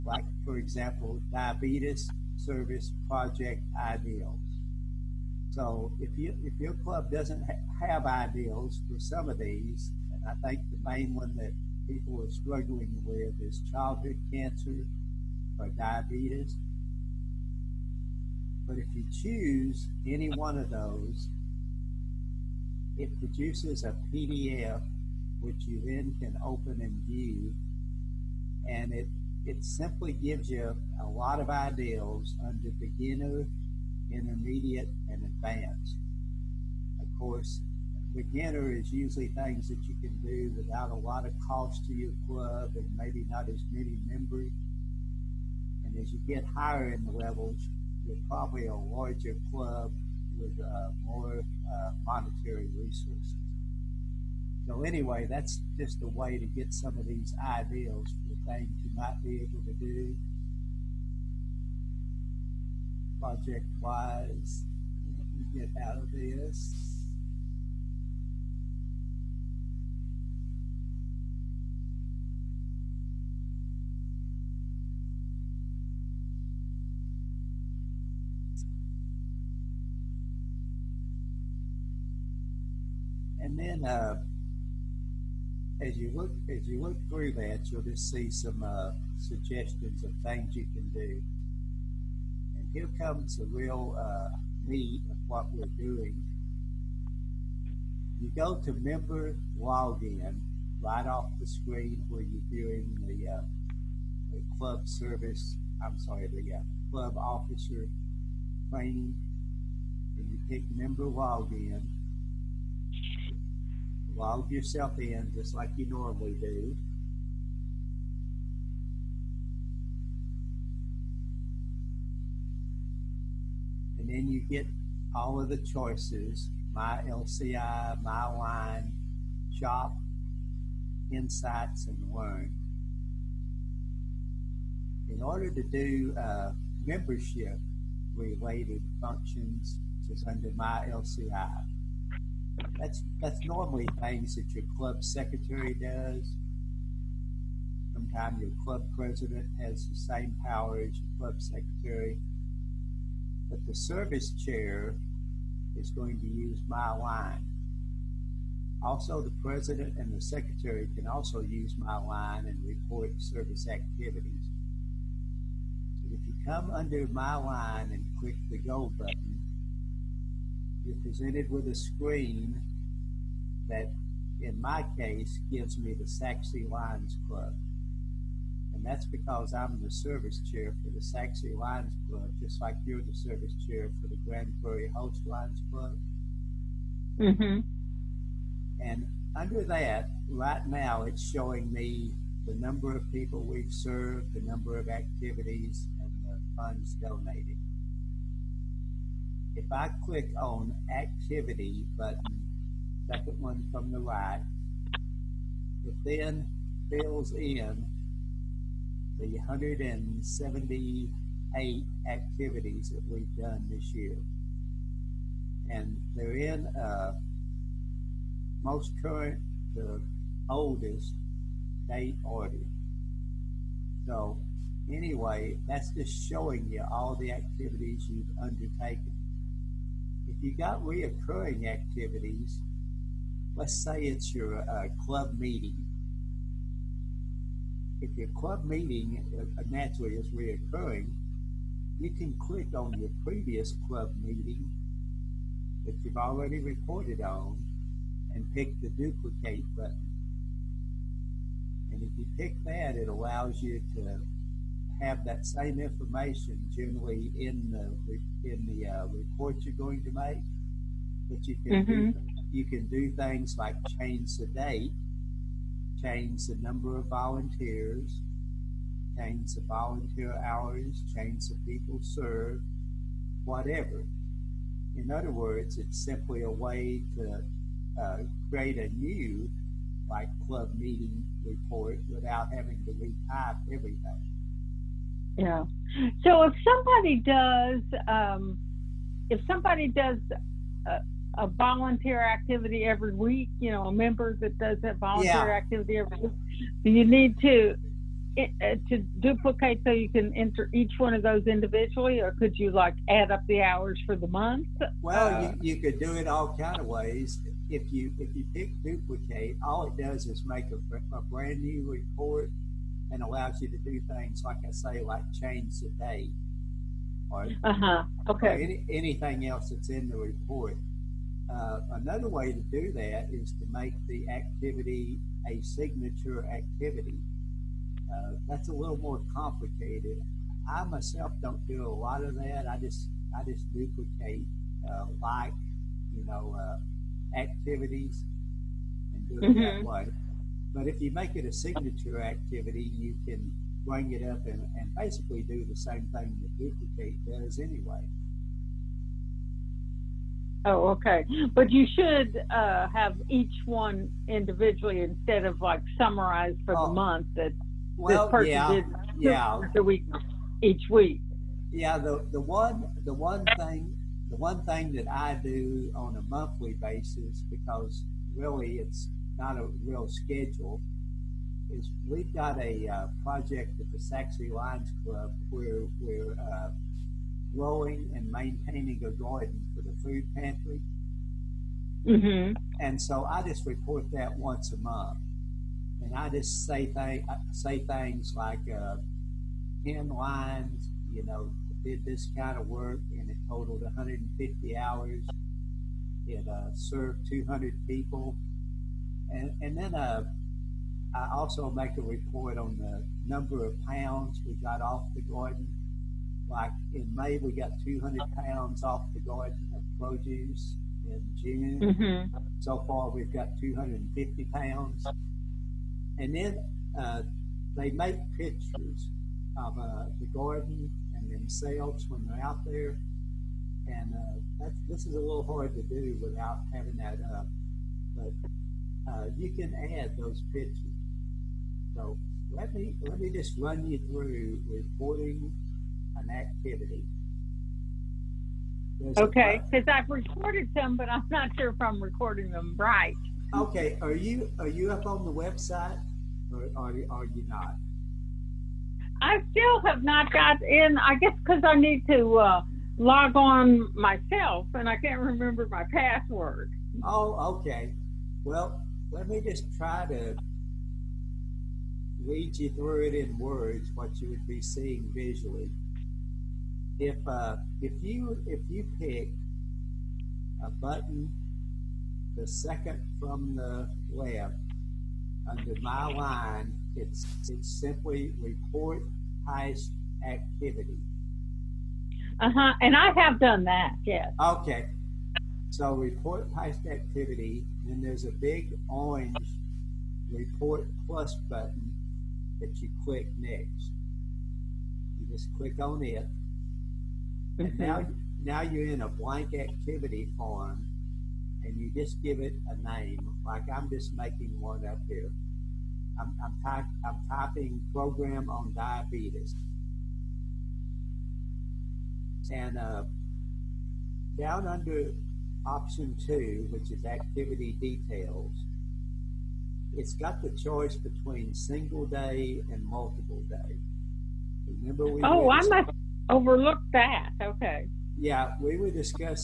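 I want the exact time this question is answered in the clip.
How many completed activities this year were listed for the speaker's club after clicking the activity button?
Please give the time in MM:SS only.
03:29.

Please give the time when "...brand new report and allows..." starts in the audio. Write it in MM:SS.
05:11.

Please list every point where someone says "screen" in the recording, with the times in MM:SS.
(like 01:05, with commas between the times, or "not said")
01:41, 02:51.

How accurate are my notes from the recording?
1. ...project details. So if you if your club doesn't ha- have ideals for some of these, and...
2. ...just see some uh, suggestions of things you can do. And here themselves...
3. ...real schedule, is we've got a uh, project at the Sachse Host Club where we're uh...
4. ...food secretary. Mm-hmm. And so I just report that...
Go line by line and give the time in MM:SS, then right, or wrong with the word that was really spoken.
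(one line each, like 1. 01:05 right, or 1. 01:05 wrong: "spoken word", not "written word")
1. 00:03 wrong: "ideals", not "details"
2. 01:27 wrong: "comes", not "themselves"
3. 06:09 wrong: "Lions", not "Host"
4. 06:20 wrong: "pantry", not "secretary".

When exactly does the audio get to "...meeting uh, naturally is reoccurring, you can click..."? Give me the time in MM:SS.
03:58.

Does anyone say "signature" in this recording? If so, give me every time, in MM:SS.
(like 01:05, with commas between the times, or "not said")
05:25, 05:41.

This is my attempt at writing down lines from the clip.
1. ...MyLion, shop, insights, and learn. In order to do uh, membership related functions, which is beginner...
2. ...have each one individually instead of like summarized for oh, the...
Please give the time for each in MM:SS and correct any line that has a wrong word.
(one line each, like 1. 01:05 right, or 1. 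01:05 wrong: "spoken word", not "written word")
1. 02:08 wrong: "under", not "beginner"
2. 05:52 right.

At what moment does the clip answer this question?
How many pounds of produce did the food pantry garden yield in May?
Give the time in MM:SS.
06:47.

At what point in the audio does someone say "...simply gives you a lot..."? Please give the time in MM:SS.
00:29.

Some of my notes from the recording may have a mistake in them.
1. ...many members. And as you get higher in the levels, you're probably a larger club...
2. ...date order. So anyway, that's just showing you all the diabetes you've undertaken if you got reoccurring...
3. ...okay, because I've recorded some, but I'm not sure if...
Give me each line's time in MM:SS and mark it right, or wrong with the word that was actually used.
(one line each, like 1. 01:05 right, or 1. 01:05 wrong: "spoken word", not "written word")
1. 00:43 right
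2. 03:41 wrong: "activities", not "diabetes"
3. 07:19 right.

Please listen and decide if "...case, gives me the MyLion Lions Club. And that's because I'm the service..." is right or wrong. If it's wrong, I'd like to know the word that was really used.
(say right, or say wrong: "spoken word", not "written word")
wrong: "Sachse", not "MyLion".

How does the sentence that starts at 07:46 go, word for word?
If uh, if you if you pick a button, the second from the left under MyLion, it's it's simply report highest activity.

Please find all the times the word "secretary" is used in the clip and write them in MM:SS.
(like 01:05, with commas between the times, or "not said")
02:25, 02:31, 02:40.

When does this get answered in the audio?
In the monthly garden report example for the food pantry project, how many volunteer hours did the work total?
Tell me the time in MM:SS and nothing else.
06:33.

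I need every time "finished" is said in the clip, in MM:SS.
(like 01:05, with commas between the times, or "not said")
not said.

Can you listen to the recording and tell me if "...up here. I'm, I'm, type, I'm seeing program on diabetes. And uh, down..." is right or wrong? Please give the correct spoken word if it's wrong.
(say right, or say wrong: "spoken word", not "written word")
wrong: "typing", not "seeing".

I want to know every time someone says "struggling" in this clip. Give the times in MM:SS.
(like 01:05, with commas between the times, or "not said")
00:12.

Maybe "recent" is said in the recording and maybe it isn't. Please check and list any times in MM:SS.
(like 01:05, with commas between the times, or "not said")
not said.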